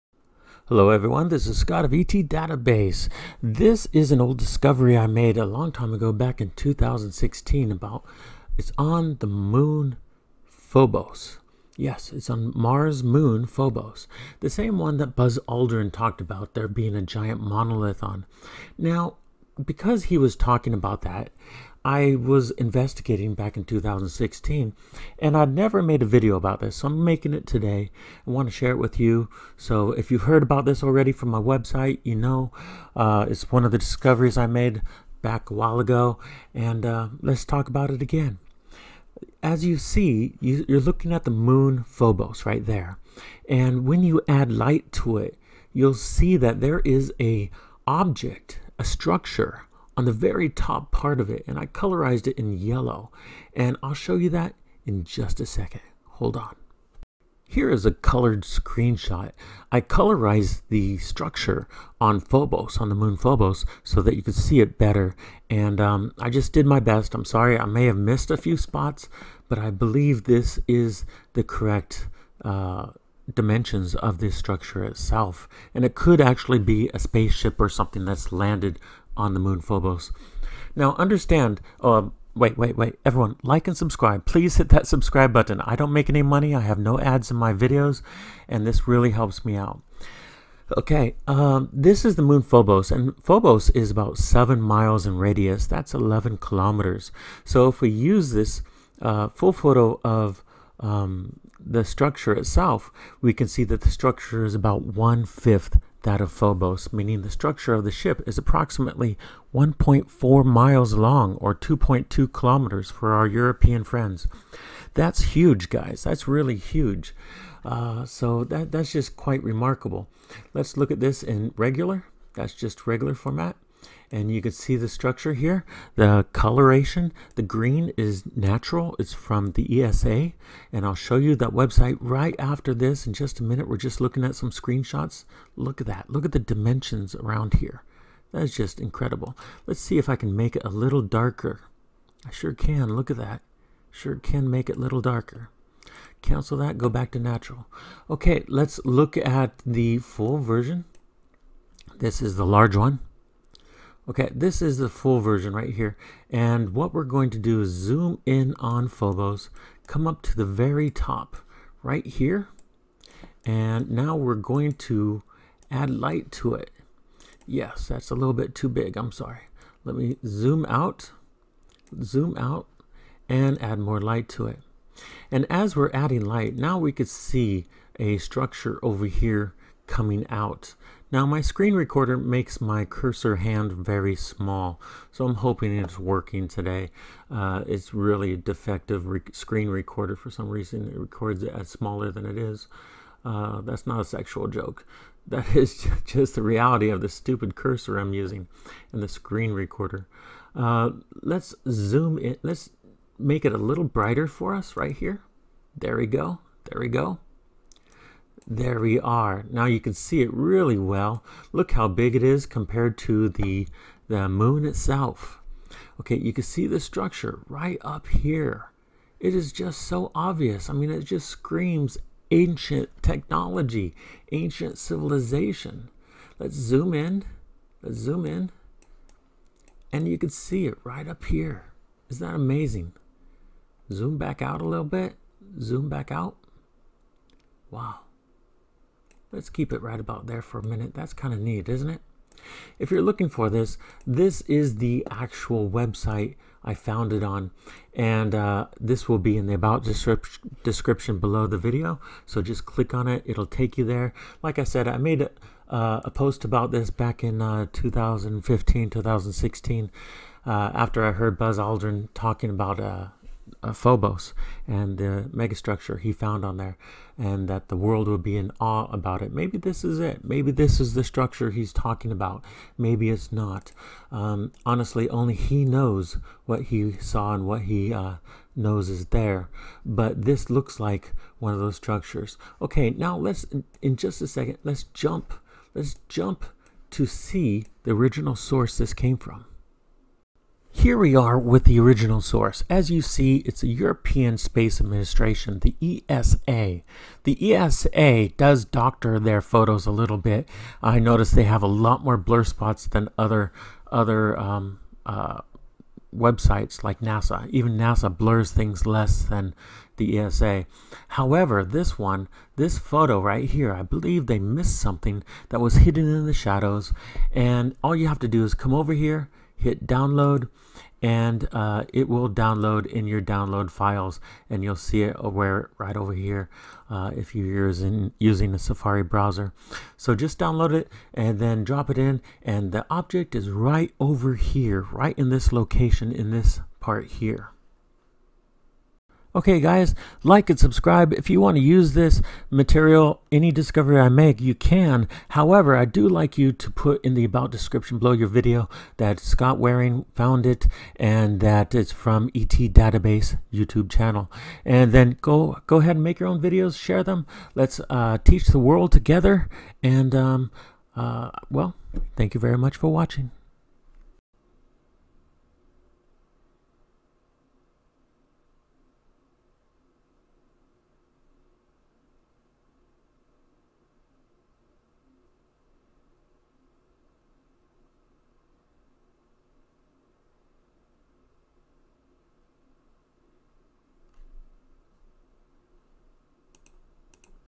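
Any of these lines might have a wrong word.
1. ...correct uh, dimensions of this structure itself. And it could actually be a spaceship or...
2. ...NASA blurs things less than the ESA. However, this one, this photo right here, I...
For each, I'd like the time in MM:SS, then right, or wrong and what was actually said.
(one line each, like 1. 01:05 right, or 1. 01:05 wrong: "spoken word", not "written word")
1. 01:11 right
2. 05:07 right.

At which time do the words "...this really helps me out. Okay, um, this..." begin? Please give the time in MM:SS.
01:28.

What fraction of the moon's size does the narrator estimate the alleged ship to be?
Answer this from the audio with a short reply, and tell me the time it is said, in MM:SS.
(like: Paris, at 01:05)
One-fifth, at 01:44.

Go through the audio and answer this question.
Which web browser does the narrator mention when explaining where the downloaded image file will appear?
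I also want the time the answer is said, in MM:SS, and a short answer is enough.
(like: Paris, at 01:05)
Safari, at 05:28.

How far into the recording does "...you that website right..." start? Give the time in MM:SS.
02:11.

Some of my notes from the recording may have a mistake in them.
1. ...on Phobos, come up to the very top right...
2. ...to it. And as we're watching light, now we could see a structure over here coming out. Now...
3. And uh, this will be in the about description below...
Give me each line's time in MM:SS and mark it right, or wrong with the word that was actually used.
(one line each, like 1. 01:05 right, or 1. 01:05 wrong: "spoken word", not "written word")
1. 02:38 right
2. 02:54 wrong: "adding", not "watching"
3. 04:07 right.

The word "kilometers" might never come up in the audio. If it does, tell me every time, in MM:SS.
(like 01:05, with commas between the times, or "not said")
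01:36, 01:52.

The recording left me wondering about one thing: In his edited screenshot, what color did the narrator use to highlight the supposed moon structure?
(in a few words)
Yellow.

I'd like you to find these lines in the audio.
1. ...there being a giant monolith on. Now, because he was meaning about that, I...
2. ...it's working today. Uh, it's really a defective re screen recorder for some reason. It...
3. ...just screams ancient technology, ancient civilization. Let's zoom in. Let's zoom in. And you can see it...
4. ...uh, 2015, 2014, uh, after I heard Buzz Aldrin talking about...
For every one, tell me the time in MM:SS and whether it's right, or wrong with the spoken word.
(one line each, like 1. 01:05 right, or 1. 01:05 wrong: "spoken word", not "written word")
1. 00:16 wrong: "talking", not "meaning"
2. 03:05 right
3. 03:41 right
4. 04:17 wrong: "2016", not "2014".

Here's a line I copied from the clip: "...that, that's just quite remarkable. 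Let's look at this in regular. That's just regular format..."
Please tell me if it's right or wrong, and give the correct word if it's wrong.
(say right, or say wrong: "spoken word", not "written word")
right.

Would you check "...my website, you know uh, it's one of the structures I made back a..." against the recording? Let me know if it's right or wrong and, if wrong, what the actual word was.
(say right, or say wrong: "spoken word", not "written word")
wrong: "discoveries", not "structures".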